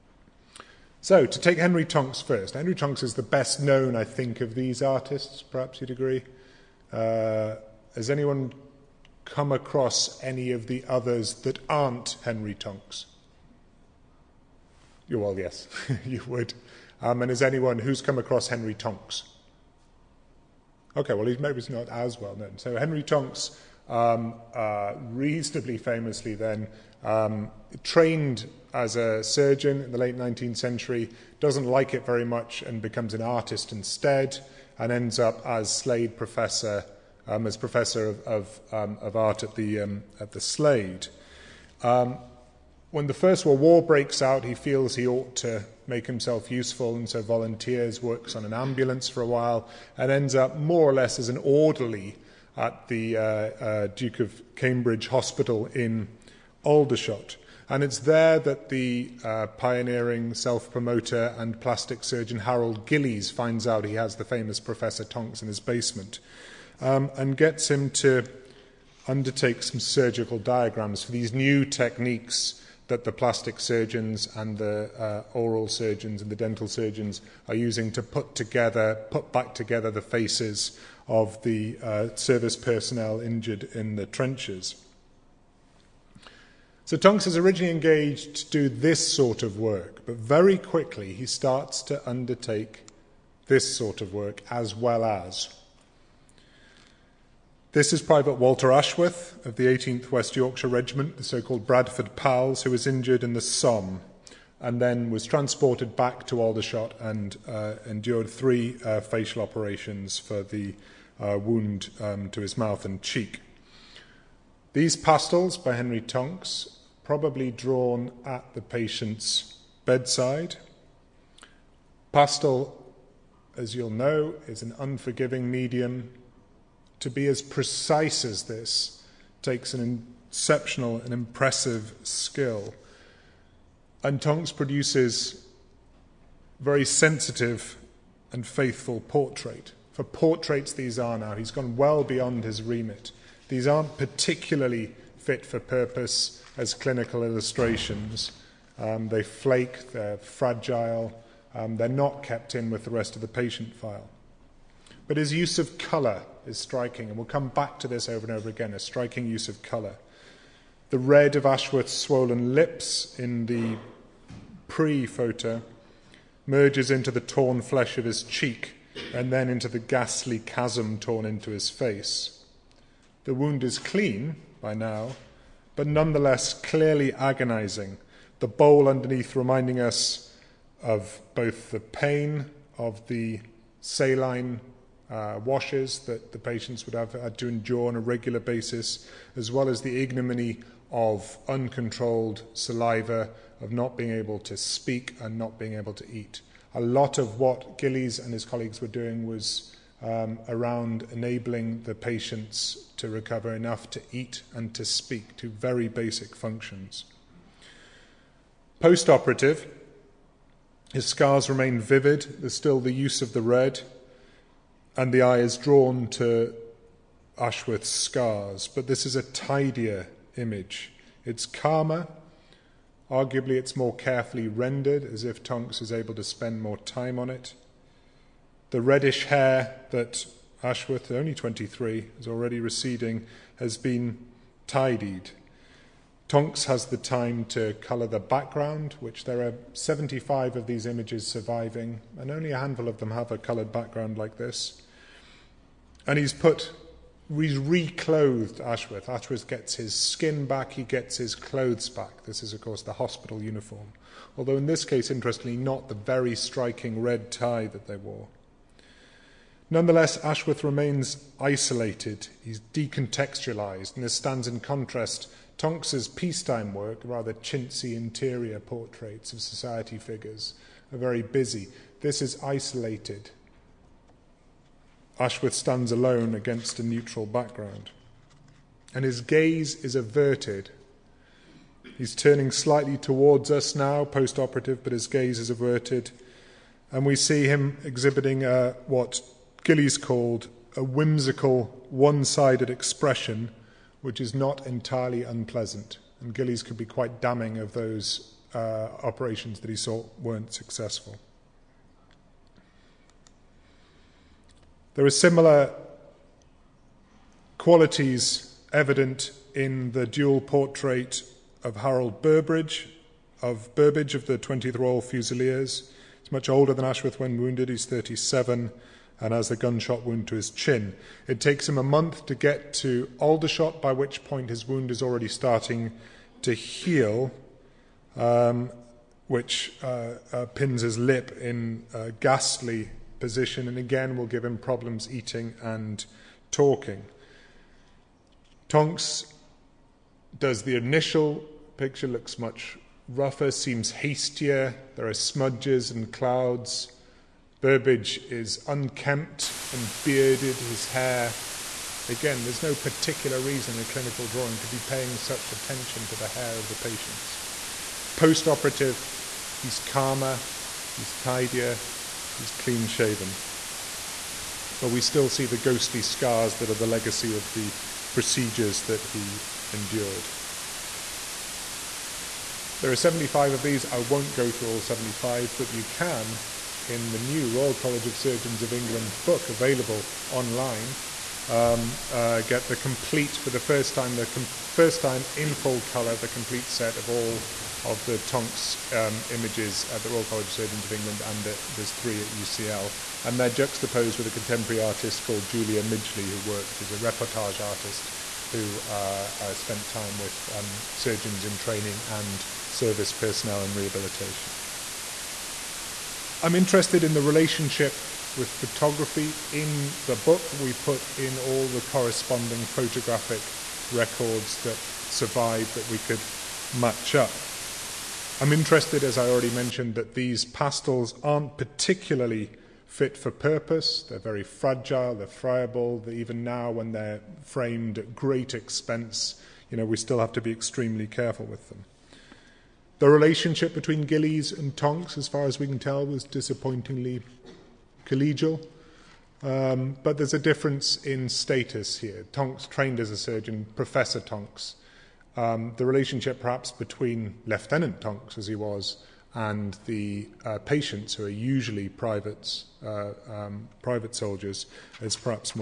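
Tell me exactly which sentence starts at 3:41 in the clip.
It's calmer, arguably, it's more carefully rendered, as if Tonks is able to spend more time on it.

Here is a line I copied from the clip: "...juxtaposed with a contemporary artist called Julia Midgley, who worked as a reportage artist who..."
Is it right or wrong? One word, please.
right.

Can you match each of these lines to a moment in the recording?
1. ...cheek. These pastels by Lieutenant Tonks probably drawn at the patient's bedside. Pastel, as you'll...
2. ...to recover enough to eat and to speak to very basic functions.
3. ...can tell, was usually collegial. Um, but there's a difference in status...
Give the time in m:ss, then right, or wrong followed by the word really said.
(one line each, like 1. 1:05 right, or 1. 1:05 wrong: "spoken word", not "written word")
1. 1:53 wrong: "Henry", not "Lieutenant"
2. 3:22 right
3. 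7:15 wrong: "disappointingly", not "usually".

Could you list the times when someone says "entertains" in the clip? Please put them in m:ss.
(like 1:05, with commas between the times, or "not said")
not said.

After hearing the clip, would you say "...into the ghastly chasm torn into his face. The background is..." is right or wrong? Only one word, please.
wrong.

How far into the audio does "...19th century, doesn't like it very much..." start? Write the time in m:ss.
0:30.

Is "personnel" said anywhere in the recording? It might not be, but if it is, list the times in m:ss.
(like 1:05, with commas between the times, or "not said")
1:22, 6:43.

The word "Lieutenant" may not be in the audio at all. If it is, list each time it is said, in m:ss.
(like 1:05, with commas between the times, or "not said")
7:27.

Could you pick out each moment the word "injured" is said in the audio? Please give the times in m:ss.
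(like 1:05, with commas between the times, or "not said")
1:23, 1:42.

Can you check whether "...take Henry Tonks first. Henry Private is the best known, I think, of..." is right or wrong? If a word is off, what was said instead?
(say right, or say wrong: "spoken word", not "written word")
wrong: "Tonks", not "Private".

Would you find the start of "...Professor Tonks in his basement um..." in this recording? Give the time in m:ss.
1:04.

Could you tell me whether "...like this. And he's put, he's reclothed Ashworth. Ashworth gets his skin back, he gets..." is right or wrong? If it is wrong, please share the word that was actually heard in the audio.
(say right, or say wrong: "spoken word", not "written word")
right.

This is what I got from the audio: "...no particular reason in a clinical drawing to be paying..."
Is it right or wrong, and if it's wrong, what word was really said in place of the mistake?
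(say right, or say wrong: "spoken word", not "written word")
right.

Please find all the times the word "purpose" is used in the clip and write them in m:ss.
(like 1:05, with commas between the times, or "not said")
2:25, 7:03.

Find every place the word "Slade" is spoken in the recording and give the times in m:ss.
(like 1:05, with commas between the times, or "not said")
0:35, 0:40.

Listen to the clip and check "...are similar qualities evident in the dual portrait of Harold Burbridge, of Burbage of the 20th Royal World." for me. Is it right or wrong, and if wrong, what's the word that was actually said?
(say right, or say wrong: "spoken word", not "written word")
wrong: "Fusiliers", not "World".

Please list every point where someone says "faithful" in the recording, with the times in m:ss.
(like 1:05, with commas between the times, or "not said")
2:18.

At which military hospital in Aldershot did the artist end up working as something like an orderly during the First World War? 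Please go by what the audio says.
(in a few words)
Duke of Cambridge Hospital.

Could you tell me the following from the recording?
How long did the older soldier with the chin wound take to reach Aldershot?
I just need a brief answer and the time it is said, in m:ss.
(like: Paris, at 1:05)
A month, at 5:21.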